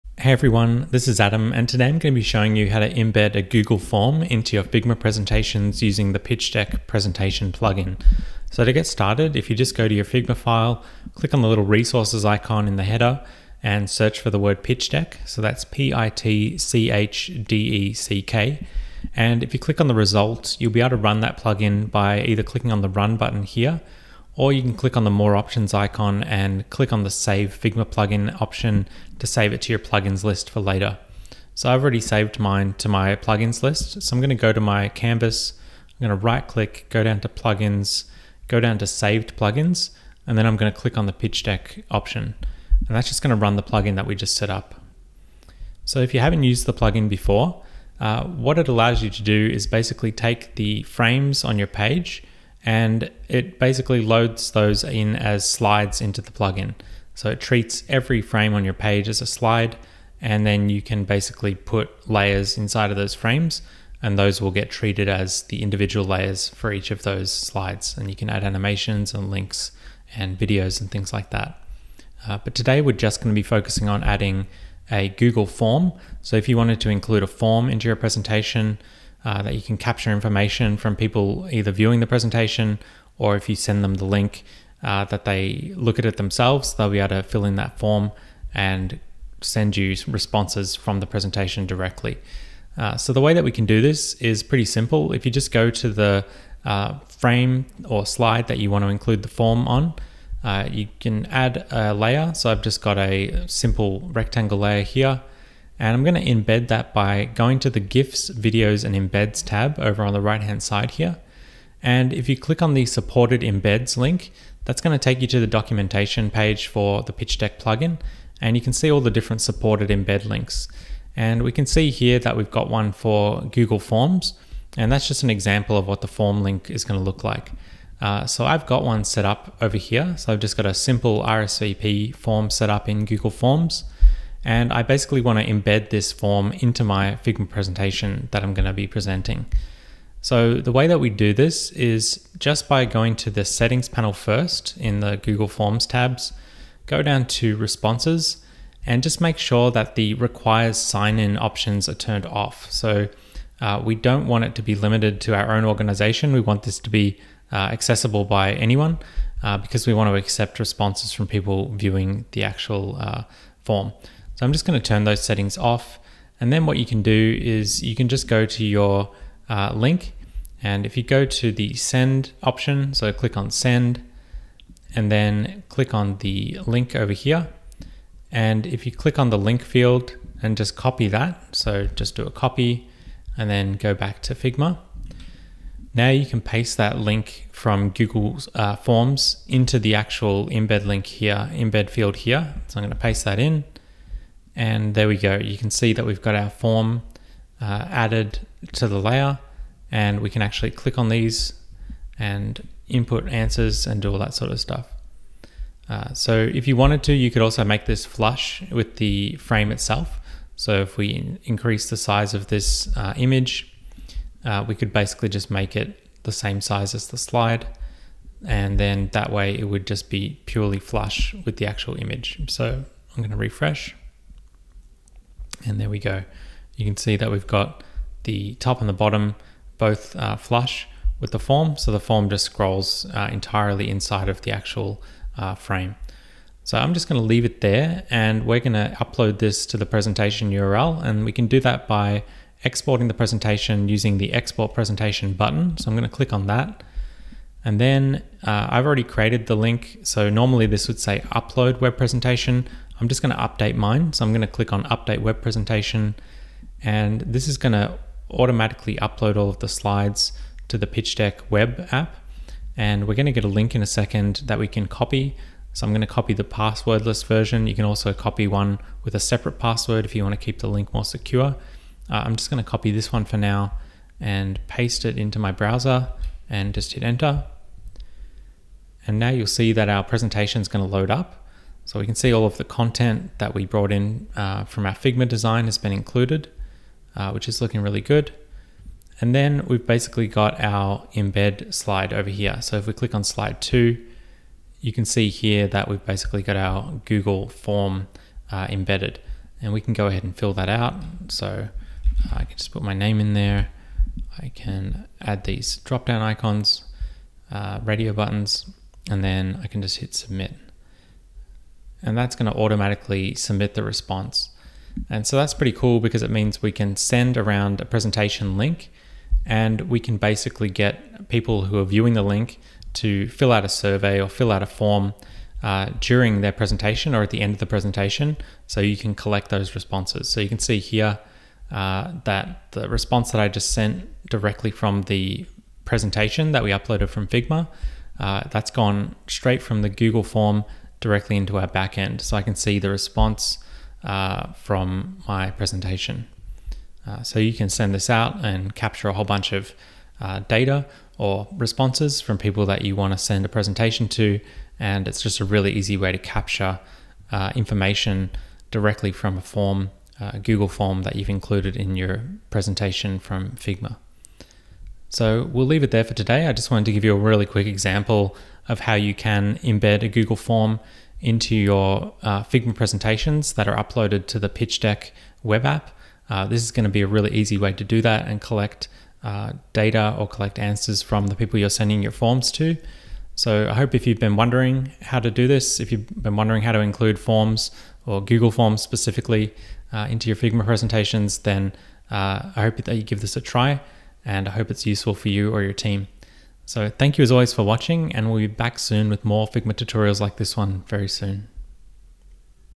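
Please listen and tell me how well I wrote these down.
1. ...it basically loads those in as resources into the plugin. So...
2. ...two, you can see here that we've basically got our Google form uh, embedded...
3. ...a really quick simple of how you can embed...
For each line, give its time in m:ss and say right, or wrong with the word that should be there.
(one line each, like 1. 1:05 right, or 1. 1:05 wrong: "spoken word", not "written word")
1. 0:53 wrong: "slides", not "resources"
2. 4:53 right
3. 6:07 wrong: "example", not "simple".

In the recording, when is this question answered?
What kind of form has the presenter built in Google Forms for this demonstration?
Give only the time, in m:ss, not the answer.
2:11.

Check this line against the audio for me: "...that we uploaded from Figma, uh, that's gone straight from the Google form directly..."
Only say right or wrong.
right.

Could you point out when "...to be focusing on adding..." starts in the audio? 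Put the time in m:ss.
1:13.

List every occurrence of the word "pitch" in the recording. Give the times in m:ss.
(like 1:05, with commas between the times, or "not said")
0:06, 0:14, 0:41, 1:57, 4:20, 6:14.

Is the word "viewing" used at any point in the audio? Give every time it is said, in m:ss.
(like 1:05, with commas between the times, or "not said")
1:21, 2:41, 5:21.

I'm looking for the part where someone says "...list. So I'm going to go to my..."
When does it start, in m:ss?
0:33.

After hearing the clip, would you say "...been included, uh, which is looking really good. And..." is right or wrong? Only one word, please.
right.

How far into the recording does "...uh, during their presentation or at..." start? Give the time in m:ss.
5:25.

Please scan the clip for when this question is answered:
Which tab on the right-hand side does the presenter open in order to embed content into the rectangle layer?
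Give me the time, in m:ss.
1:47.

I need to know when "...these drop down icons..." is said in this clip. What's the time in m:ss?
5:05.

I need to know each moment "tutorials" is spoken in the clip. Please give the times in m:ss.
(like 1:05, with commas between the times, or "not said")
6:39.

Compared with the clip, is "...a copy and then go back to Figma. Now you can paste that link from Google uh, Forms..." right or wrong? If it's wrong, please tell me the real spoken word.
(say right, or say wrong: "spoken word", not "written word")
right.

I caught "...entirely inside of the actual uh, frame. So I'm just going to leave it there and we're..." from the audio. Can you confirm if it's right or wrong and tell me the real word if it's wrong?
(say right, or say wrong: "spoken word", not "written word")
right.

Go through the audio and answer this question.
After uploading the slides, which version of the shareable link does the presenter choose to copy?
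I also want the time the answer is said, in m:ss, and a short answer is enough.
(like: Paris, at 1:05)
passwordless version, at 4:26.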